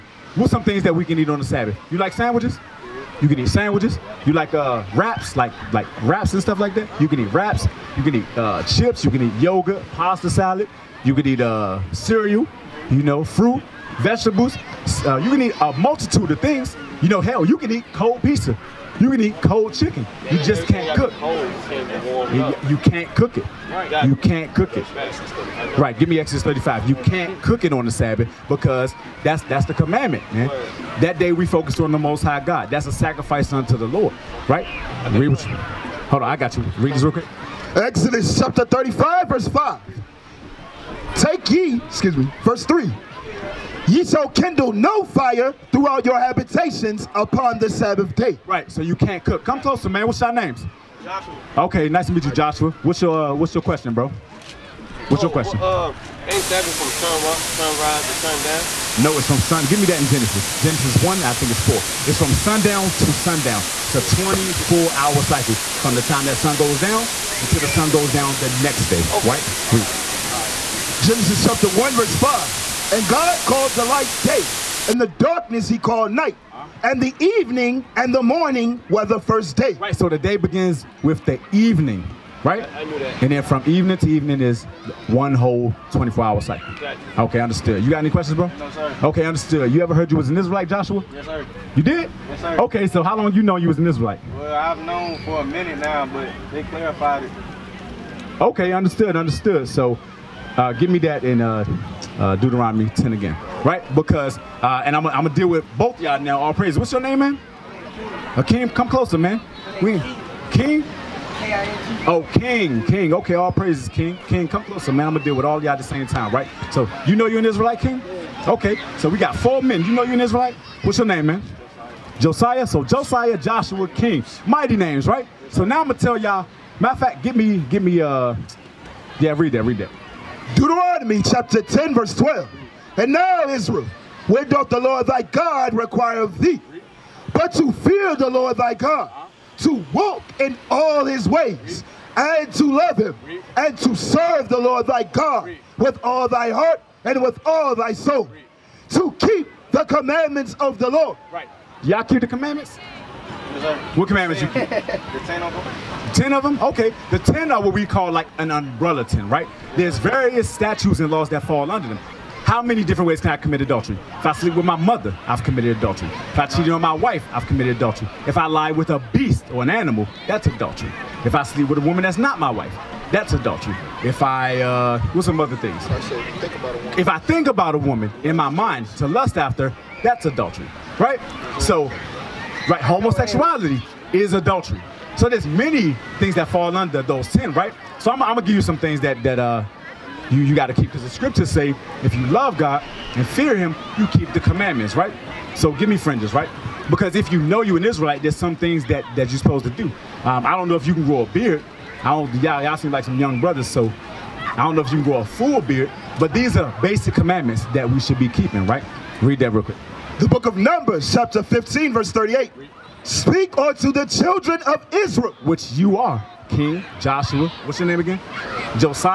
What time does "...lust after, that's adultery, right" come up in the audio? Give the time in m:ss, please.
2:59.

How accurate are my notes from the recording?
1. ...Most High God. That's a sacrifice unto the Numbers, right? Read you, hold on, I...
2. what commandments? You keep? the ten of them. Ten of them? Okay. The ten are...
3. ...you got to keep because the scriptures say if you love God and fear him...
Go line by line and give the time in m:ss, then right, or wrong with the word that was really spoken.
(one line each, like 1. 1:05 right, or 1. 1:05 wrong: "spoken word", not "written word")
1. 0:31 wrong: "Lord", not "Numbers"
2. 2:33 right
3. 3:10 right.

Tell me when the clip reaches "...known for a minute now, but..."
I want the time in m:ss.
1:34.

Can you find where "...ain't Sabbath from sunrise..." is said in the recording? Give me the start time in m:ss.
0:56.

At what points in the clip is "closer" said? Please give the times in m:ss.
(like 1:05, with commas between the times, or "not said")
0:49, 1:48, 1:54.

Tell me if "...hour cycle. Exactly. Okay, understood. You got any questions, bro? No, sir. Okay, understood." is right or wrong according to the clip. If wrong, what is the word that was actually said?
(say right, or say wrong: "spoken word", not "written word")
right.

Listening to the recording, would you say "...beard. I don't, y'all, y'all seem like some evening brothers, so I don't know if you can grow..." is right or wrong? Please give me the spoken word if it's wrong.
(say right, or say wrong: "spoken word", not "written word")
wrong: "young", not "evening".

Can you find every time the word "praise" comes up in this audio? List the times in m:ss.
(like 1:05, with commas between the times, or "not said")
1:46, 1:53.